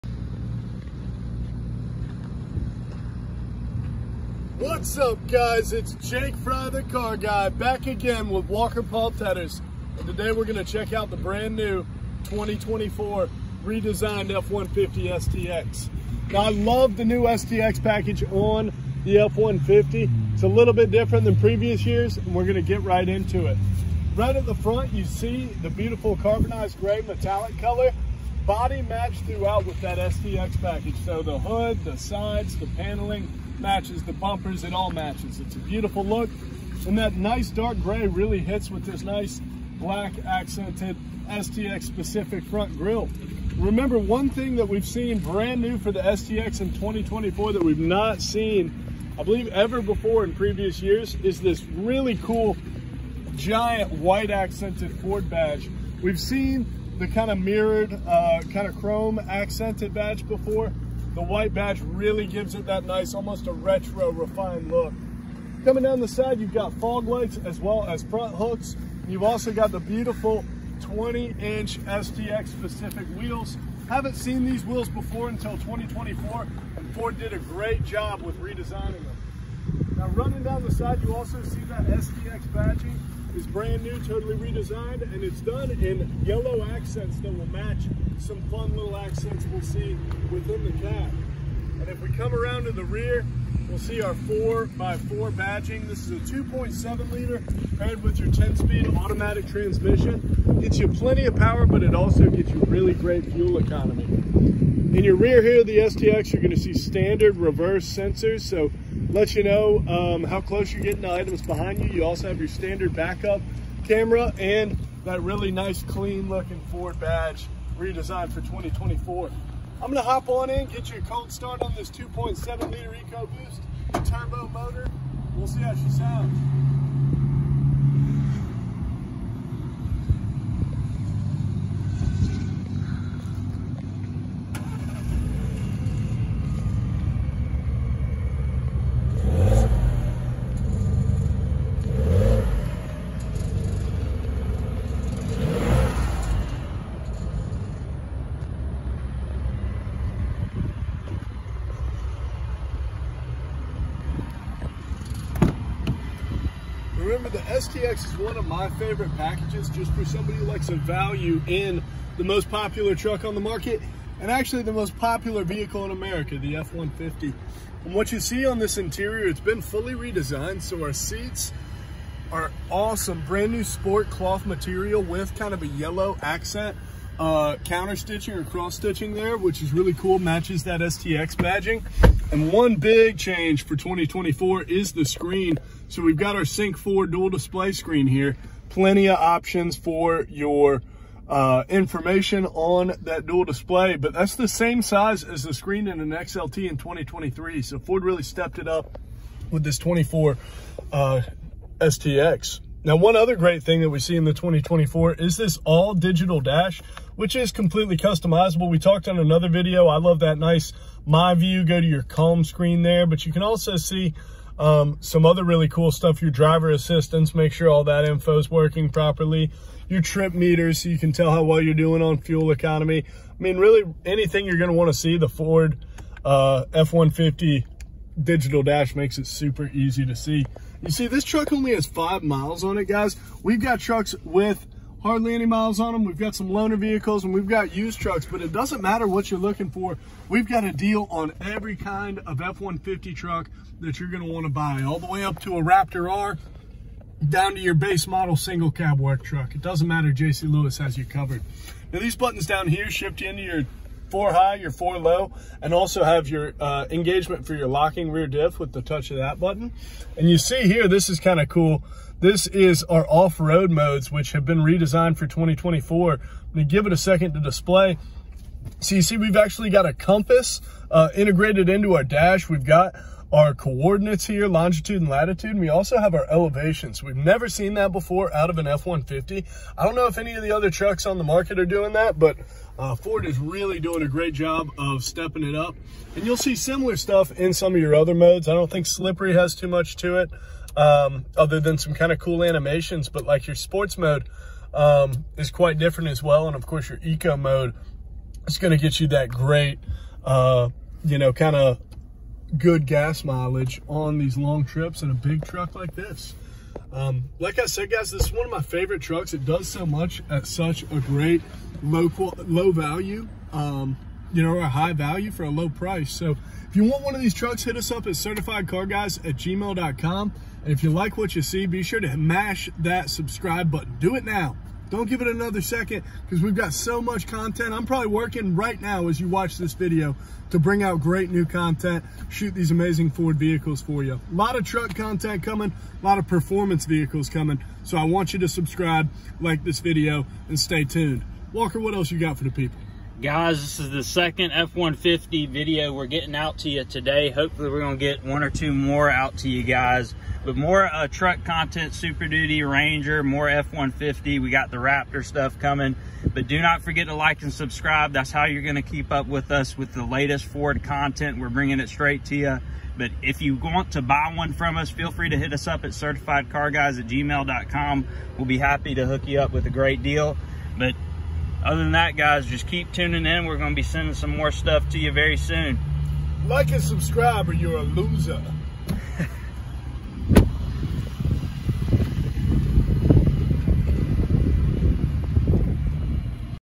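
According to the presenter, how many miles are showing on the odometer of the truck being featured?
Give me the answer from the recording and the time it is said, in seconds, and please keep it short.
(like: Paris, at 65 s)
5, at 231 s.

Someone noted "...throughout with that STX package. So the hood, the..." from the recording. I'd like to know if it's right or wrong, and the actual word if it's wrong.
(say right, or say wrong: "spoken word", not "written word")
right.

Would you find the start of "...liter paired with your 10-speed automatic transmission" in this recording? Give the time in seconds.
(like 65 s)
97 s.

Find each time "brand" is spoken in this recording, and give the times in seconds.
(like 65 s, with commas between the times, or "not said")
11 s, 45 s, 83 s, 173 s.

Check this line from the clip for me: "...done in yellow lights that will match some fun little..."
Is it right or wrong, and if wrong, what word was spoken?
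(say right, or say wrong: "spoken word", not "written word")
wrong: "accents", not "lights".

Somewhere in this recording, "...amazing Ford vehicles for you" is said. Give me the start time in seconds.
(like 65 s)
332 s.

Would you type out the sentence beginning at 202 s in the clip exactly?
Now, one other great thing that we see in the 2024 is this all digital dash, which is completely customizable.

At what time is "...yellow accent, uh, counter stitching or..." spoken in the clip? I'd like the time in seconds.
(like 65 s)
175 s.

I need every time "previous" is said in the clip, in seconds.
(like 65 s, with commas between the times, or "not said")
21 s, 50 s.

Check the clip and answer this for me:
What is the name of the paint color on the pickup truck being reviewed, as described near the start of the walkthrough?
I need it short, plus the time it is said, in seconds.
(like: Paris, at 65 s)
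carbonized gray metallic, at 26 s.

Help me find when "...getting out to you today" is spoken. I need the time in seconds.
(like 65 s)
346 s.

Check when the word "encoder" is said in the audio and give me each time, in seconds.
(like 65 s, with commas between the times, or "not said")
not said.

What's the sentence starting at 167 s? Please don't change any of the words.
And what you see on this interior, it's been fully redesigned.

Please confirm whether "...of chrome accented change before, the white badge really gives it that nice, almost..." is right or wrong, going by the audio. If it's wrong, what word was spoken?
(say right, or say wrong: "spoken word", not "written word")
wrong: "badge", not "change".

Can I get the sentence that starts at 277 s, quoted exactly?
We've never seen that before out of an F-150.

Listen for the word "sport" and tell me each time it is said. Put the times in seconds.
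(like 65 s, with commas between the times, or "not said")
173 s, 293 s.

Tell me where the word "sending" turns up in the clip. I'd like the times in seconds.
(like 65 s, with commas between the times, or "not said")
373 s.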